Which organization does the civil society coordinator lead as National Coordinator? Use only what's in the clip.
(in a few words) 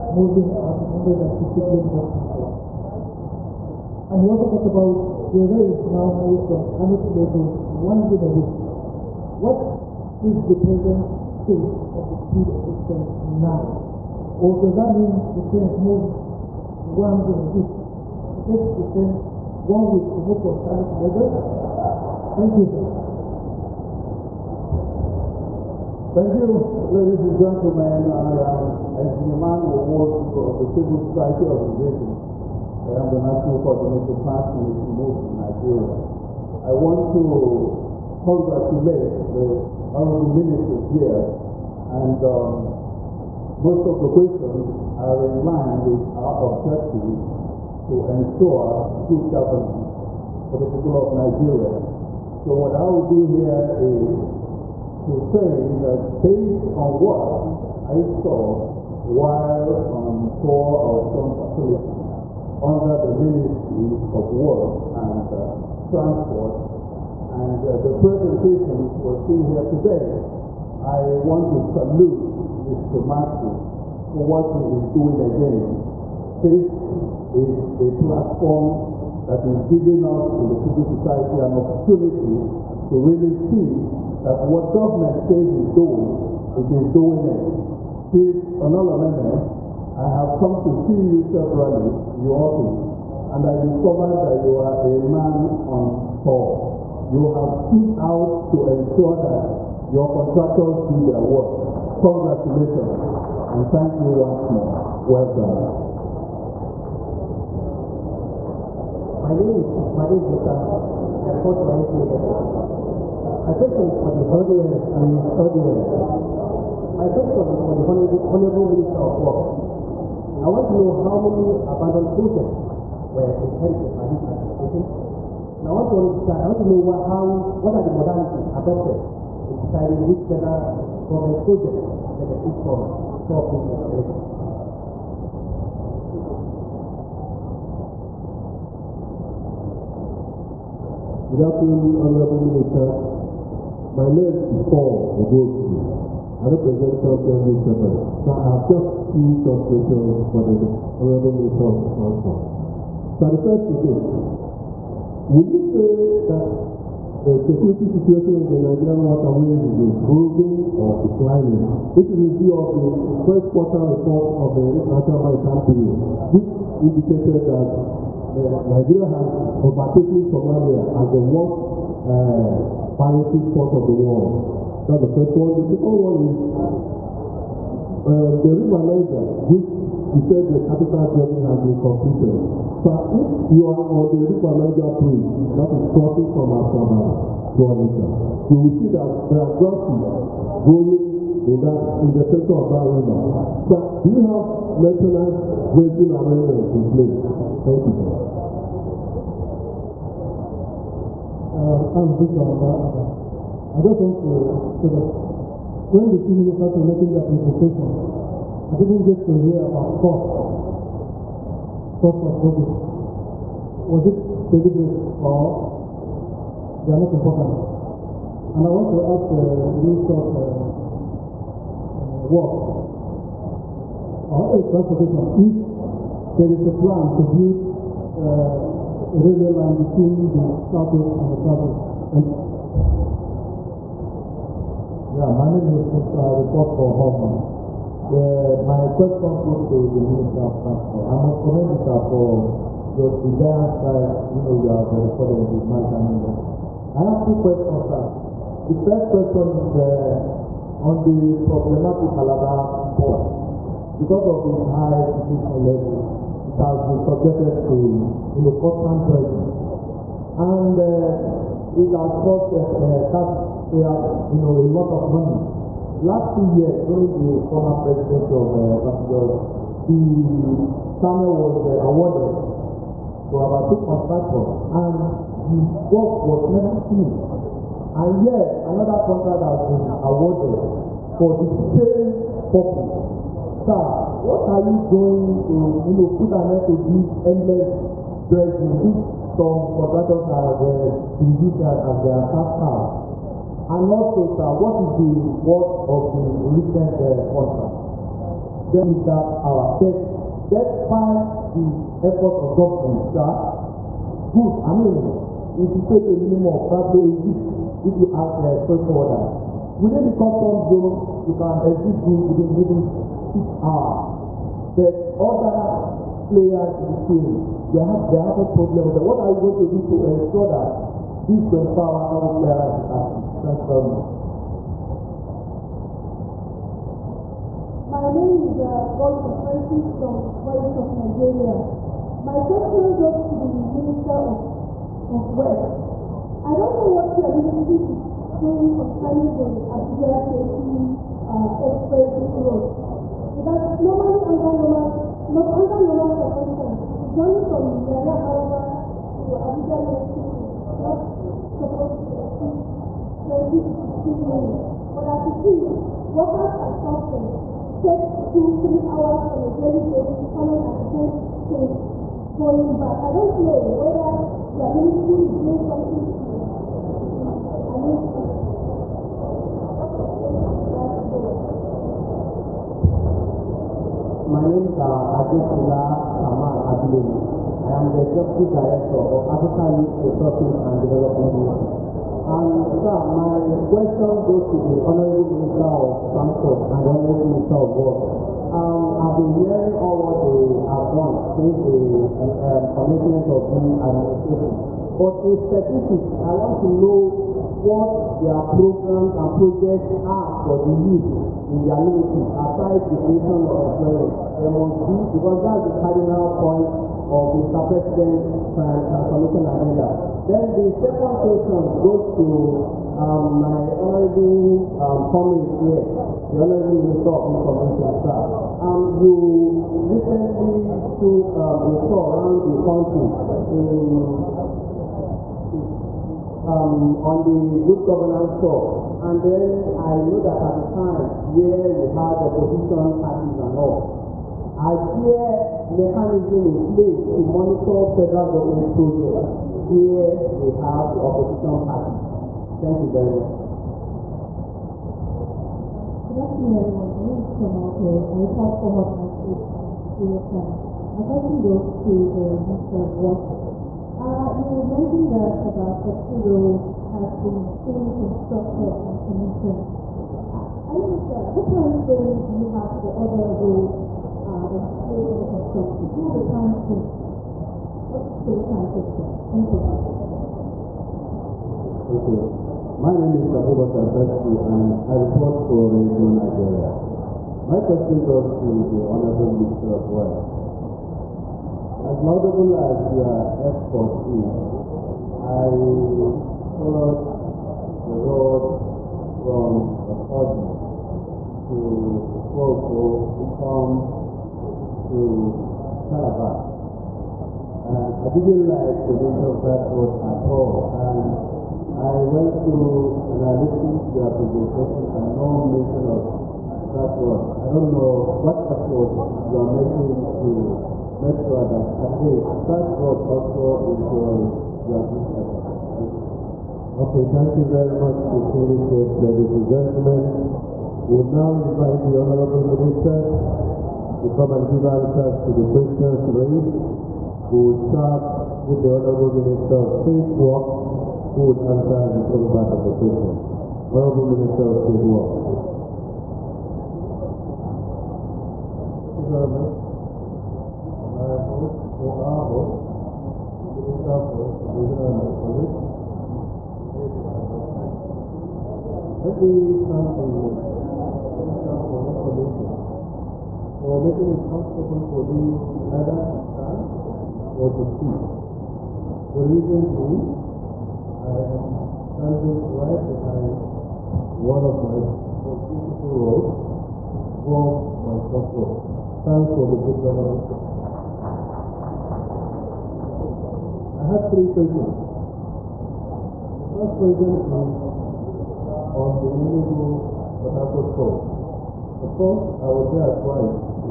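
Transformation Movement.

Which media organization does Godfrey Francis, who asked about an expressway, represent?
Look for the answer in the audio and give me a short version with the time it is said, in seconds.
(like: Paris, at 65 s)
Voice of Nigeria, at 330 s.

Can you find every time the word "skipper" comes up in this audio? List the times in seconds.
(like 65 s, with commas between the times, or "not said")
not said.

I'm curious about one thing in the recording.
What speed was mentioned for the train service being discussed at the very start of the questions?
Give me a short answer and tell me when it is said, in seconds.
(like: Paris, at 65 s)
160 km/h, at 0 s.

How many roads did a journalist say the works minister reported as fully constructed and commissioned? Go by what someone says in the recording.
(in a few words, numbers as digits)
32.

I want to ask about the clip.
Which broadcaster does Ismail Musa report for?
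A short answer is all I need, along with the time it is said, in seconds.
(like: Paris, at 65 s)
NTA, at 111 s.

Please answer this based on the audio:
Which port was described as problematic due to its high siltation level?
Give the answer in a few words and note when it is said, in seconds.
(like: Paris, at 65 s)
Calabar port, at 252 s.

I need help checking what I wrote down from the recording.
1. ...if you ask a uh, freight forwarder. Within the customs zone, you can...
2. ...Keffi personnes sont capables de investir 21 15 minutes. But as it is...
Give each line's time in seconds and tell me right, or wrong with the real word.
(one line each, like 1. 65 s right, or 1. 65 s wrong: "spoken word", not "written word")
1. 307 s right
2. 349 s wrong: "20", not "21".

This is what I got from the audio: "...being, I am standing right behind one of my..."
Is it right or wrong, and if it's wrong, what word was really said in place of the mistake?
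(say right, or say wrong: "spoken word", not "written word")
right.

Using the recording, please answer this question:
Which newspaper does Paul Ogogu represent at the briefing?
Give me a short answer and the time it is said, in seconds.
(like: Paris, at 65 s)
Champion Newspapers, at 147 s.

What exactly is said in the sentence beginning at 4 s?
And he also talked about the rails now moves from Kano to Lagos once in a week.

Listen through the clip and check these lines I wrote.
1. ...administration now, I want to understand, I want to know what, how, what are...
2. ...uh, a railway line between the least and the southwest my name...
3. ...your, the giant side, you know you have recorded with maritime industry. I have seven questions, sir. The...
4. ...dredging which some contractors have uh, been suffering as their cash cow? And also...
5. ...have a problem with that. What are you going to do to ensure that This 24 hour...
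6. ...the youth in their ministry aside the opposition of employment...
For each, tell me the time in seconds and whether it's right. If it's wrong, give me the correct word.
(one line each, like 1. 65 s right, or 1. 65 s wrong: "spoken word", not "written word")
1. 124 s right
2. 228 s wrong: "southwest", not "least"
3. 243 s wrong: "two", not "seven"
4. 288 s wrong: "using", not "suffering"
5. 318 s right
6. 400 s wrong: "creation", not "opposition".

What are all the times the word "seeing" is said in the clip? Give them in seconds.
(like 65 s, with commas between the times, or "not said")
69 s.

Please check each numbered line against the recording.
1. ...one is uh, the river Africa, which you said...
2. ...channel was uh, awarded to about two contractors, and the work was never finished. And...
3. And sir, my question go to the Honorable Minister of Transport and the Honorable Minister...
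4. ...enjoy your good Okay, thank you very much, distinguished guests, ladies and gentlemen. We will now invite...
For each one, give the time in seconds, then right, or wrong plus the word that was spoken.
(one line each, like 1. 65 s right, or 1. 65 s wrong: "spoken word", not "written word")
1. 176 s wrong: "Niger", not "Africa"
2. 270 s right
3. 382 s right
4. 513 s right.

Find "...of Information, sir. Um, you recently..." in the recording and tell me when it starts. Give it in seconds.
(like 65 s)
417 s.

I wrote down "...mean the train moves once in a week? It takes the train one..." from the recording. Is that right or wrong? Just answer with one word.
right.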